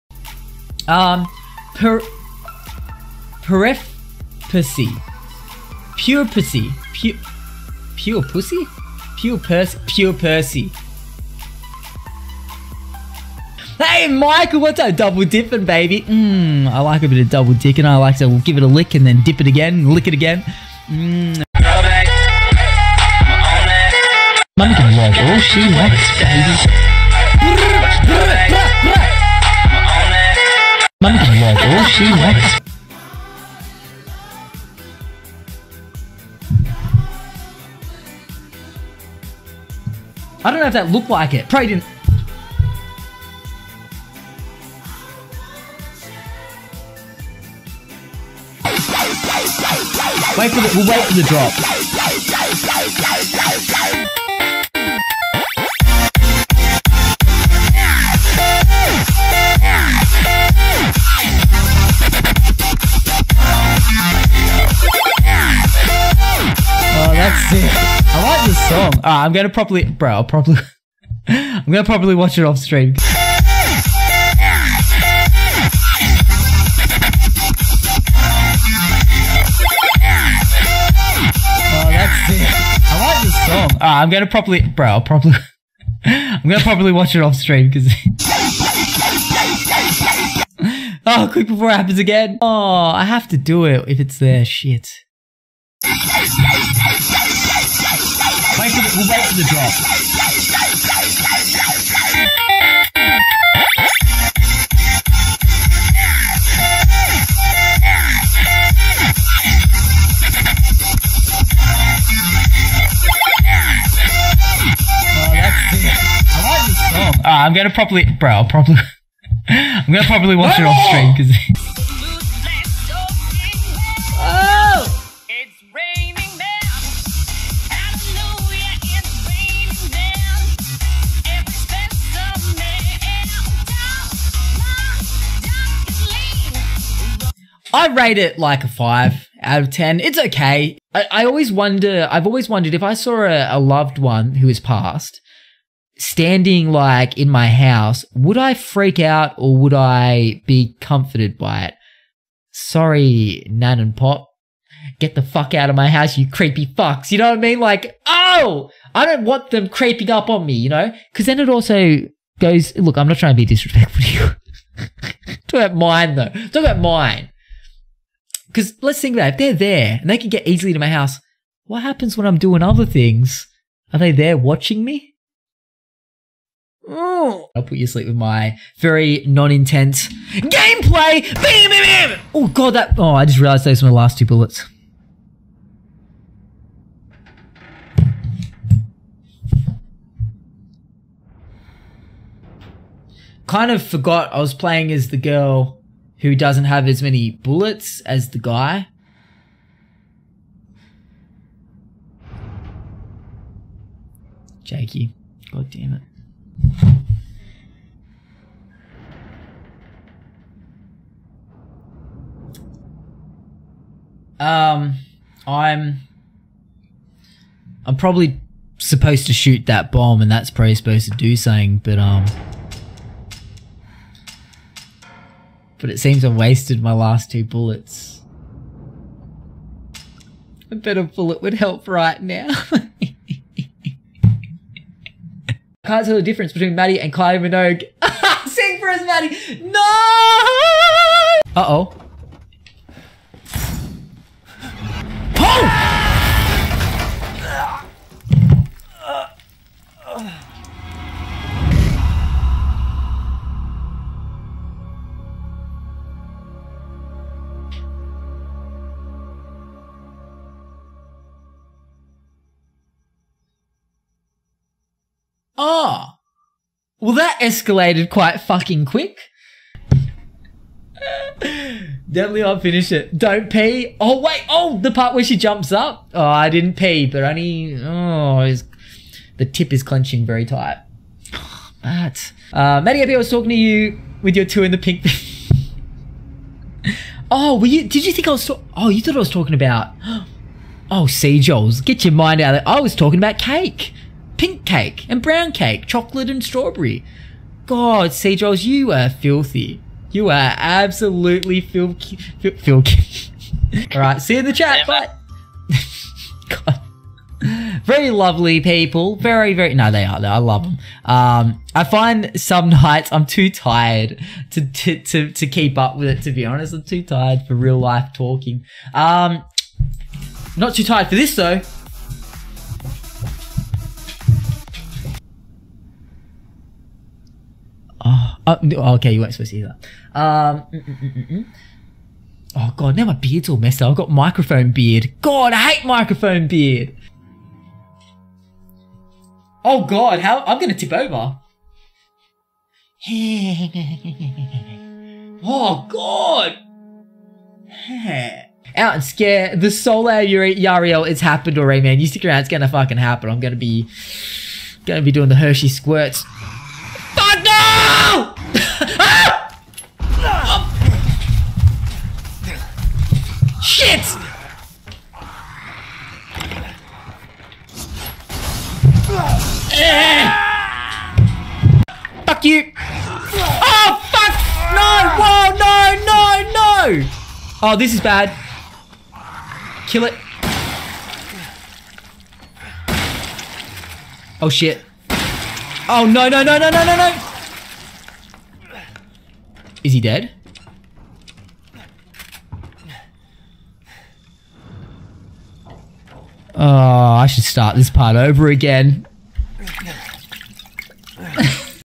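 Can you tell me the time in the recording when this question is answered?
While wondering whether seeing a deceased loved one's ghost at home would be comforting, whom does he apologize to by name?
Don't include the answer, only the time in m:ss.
2:33.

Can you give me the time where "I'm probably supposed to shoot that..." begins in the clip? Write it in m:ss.
3:37.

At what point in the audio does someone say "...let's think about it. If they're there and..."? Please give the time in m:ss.
2:48.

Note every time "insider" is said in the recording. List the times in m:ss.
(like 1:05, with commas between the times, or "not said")
not said.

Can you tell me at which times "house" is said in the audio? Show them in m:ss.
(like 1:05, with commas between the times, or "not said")
2:27, 2:35, 2:50.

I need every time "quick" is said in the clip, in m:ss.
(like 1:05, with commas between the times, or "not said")
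1:31, 4:28.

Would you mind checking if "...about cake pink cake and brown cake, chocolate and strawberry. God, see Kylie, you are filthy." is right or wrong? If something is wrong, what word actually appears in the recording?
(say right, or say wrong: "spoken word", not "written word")
wrong: "Jones", not "Kylie".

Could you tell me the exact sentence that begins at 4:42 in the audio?
Uh, Maddie I was talking to you with your two in the pink.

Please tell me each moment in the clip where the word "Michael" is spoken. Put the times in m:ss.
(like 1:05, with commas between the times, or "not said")
0:14.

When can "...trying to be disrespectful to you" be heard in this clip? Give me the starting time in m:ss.
2:43.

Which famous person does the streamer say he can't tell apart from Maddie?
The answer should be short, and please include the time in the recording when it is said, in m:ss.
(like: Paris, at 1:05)
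Kylie Minogue, at 3:57.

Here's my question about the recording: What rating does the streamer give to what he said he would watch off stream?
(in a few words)
5 out of 10.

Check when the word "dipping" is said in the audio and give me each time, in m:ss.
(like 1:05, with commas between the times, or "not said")
0:15.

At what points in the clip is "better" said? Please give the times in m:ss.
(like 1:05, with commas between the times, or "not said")
3:50.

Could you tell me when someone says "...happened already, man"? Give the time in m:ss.
5:51.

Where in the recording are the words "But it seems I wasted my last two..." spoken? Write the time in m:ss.
3:45.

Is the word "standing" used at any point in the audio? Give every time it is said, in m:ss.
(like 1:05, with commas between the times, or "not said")
2:25.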